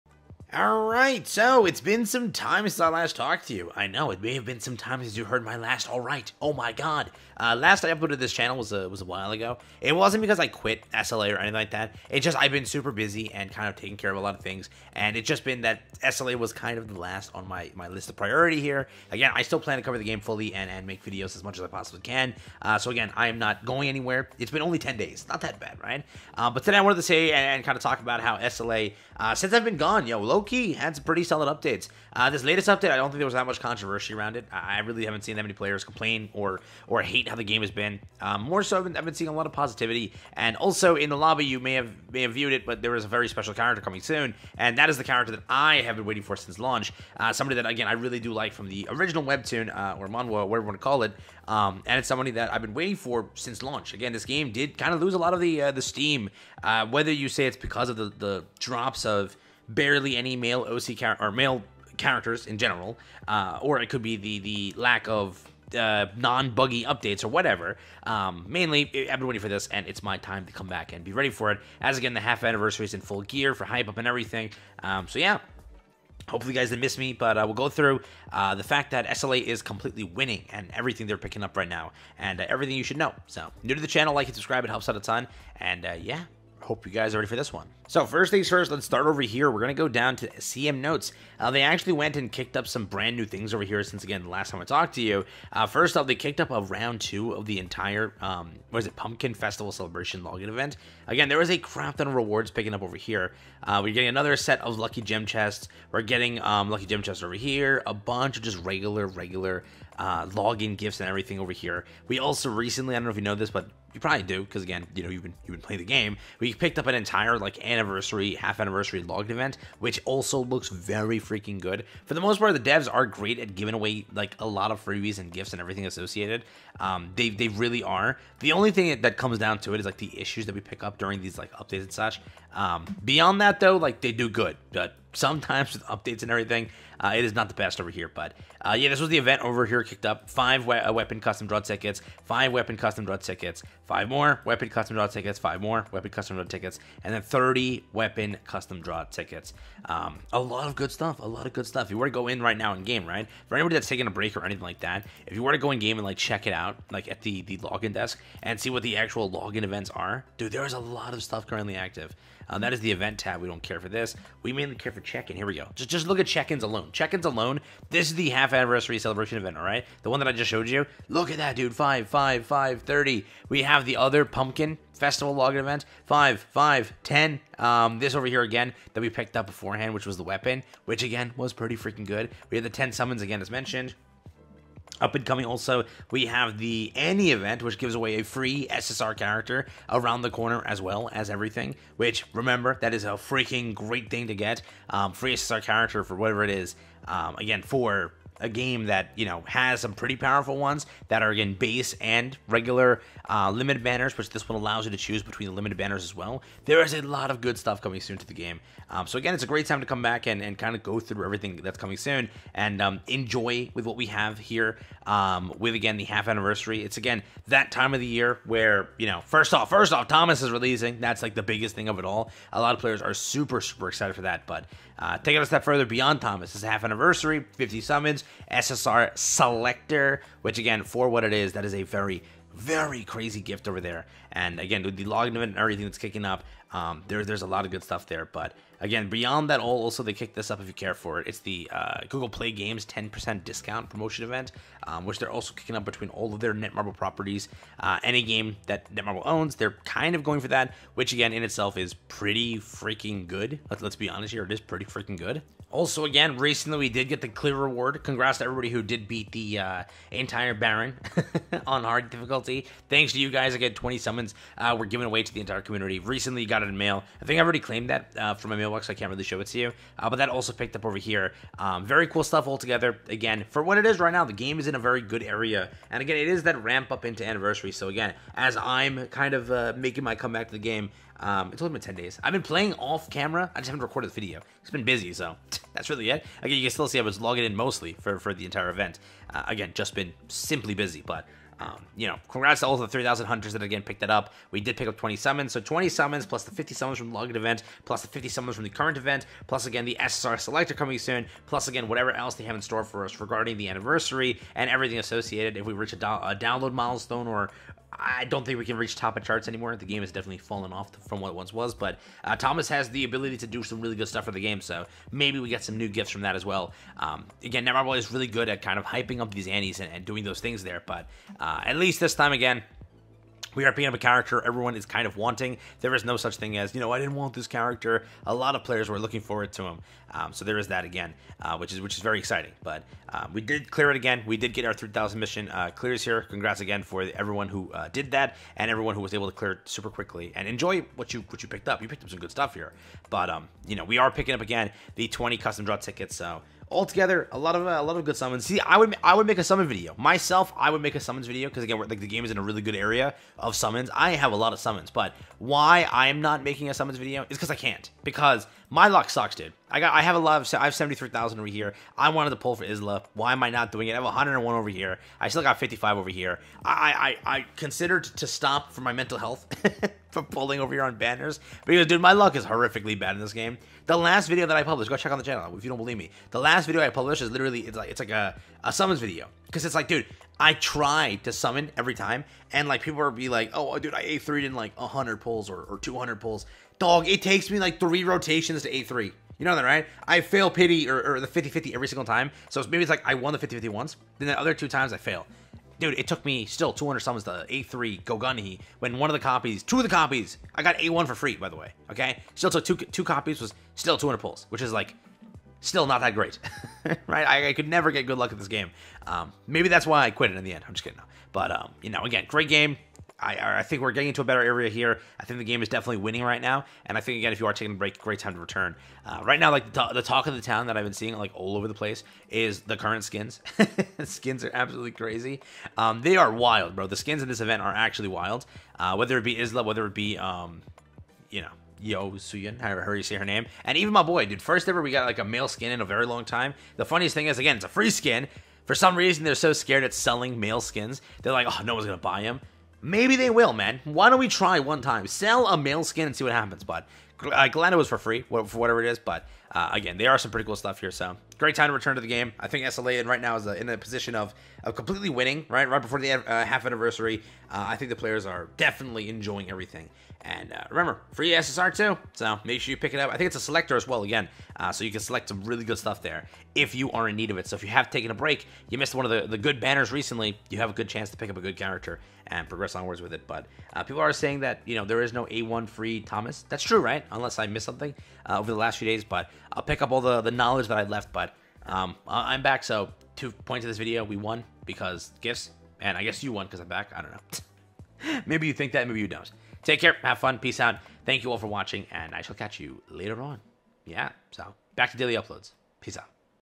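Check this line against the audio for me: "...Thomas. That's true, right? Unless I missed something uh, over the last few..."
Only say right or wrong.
right.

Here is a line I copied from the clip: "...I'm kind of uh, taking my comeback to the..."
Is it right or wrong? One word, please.
wrong.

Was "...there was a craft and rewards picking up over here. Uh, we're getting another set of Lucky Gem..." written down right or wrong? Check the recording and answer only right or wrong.
right.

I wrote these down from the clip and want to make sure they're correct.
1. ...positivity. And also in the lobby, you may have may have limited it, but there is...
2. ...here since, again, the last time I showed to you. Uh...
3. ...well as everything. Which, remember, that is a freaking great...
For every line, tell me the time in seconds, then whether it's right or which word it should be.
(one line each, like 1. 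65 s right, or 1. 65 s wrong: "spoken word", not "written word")
1. 39 s wrong: "viewed", not "limited"
2. 93 s wrong: "talked", not "showed"
3. 190 s right.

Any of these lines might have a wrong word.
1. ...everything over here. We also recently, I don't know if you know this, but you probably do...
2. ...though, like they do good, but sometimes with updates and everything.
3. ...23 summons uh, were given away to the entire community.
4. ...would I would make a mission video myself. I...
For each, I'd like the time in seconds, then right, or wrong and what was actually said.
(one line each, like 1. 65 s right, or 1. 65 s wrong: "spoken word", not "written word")
1. 111 s right
2. 133 s right
3. 263 s wrong: "20", not "23"
4. 348 s wrong: "summon", not "mission".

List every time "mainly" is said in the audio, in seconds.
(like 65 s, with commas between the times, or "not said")
68 s, 164 s.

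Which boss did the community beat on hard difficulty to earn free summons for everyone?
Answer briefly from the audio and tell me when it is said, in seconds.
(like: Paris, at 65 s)
Baran, at 260 s.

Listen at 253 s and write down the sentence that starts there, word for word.
Let's, let's be honest here, it is pretty freaking good.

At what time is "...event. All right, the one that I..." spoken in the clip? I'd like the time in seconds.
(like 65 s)
169 s.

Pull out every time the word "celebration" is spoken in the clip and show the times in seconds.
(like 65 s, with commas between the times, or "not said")
99 s, 168 s.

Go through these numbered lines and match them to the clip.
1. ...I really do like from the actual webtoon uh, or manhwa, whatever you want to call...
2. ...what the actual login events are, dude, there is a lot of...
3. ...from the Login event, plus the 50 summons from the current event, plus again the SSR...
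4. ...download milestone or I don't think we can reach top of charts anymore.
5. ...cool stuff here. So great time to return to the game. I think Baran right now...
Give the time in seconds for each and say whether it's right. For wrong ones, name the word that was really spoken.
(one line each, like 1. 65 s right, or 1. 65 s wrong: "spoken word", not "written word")
1. 47 s wrong: "original", not "actual"
2. 158 s right
3. 296 s right
4. 306 s right
5. 450 s wrong: "SLA", not "Baran".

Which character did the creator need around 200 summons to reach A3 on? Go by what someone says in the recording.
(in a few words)
Go Gunhee.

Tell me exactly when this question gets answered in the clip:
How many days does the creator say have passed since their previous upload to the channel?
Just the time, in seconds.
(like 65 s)
24 s.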